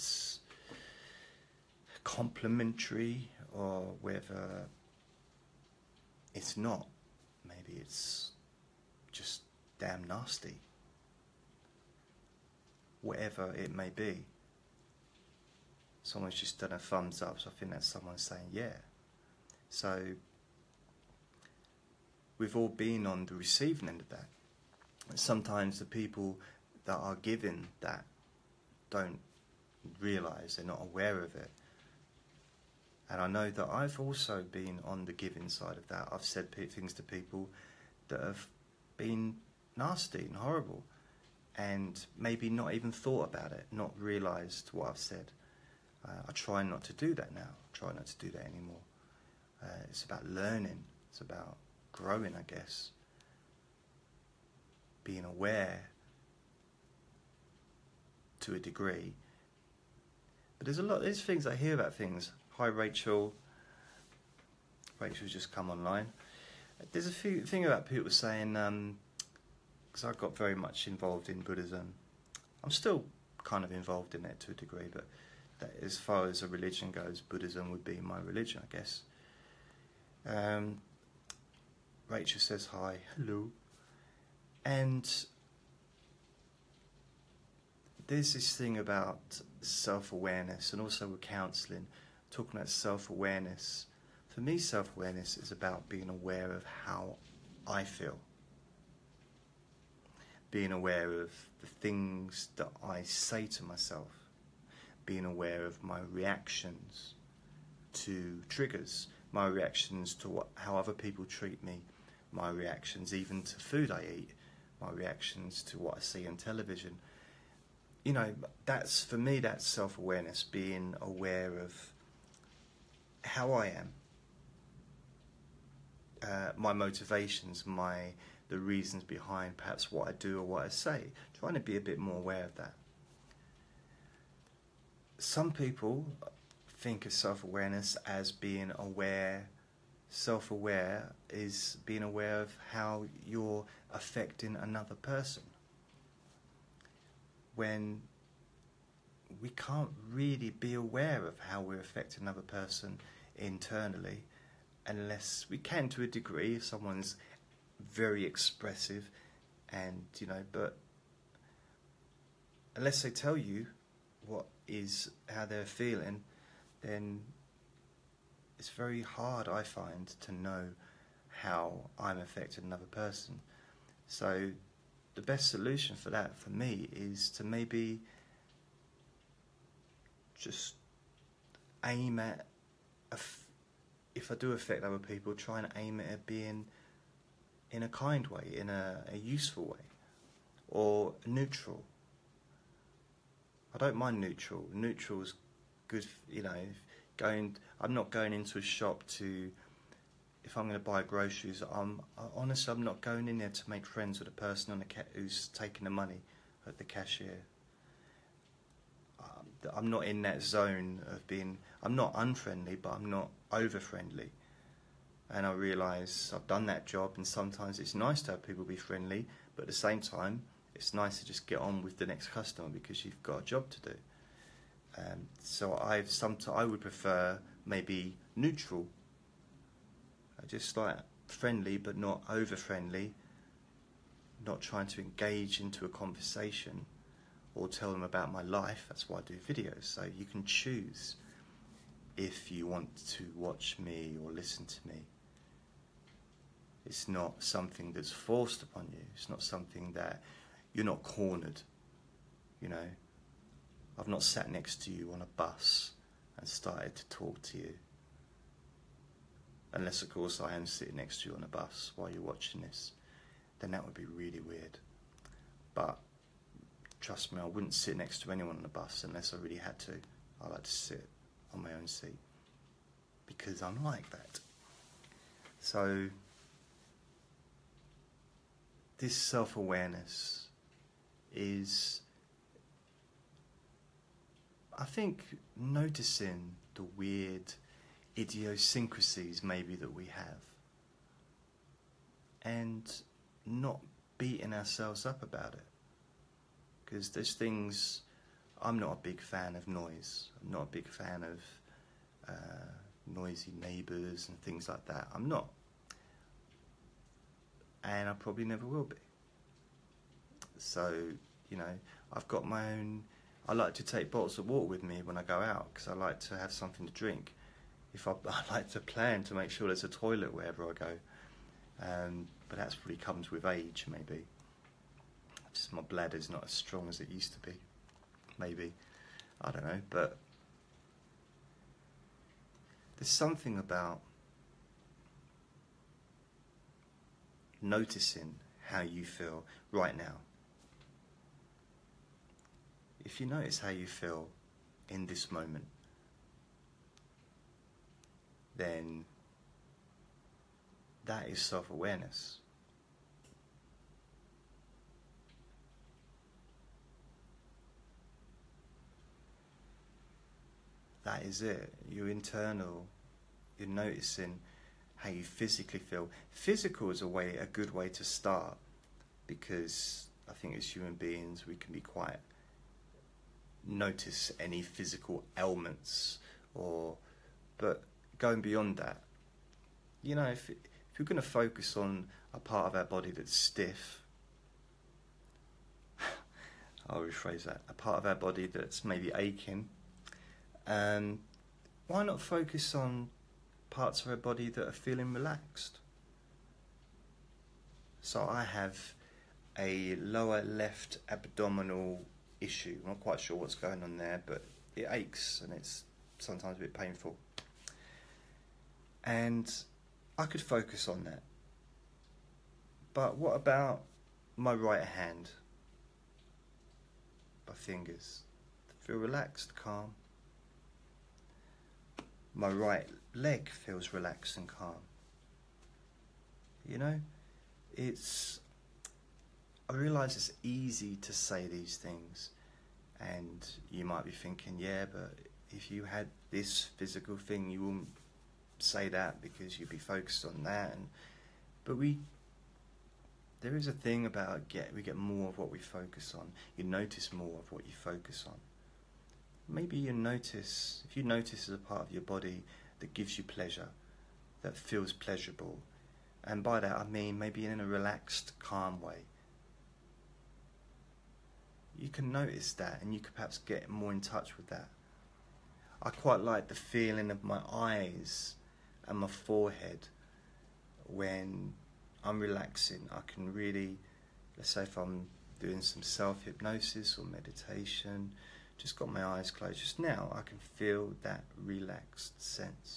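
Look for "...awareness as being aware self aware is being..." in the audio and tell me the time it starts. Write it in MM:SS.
02:17.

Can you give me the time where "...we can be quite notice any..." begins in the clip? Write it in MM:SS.
06:11.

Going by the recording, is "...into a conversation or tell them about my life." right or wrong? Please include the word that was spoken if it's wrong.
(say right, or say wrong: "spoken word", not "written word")
right.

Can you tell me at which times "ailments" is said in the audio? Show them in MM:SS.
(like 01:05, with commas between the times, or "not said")
06:15.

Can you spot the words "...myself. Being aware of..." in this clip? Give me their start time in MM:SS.
01:43.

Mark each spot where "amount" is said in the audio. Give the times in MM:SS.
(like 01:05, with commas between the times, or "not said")
not said.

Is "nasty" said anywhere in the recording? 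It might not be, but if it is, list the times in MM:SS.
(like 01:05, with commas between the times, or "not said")
00:10, 00:39.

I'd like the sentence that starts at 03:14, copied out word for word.
Neutral is good, you know going.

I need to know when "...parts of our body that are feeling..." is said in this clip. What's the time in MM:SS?
06:33.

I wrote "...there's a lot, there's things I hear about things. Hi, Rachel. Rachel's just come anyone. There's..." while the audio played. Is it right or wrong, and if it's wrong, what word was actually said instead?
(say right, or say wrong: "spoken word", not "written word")
wrong: "online", not "anyone".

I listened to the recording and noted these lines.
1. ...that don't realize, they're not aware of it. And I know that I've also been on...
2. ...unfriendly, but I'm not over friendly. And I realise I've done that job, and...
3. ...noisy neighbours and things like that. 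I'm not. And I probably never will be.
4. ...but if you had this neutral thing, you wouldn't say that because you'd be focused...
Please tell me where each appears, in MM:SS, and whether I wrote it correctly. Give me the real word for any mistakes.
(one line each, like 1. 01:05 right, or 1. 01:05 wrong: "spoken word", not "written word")
1. 00:27 right
2. 03:32 right
3. 05:03 right
4. 07:14 wrong: "physical", not "neutral".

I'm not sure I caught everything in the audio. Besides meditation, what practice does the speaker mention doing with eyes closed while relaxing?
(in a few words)
Self-hypnosis.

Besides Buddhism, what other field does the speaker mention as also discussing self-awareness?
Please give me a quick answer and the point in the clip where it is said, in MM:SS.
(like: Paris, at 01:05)
Counseling, at 01:31.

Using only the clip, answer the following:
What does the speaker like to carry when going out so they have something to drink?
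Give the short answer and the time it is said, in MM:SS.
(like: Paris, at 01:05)
Bottles of water, at 05:14.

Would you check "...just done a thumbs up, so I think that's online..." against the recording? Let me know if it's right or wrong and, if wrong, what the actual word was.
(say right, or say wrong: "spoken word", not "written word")
wrong: "someone", not "online".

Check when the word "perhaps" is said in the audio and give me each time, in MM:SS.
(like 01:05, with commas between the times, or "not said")
02:09, 07:43.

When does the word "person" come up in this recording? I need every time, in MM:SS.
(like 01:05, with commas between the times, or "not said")
02:24, 02:32, 02:52, 03:24.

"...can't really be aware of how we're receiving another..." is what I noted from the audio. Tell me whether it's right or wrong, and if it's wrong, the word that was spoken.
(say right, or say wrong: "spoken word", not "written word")
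wrong: "affecting", not "receiving".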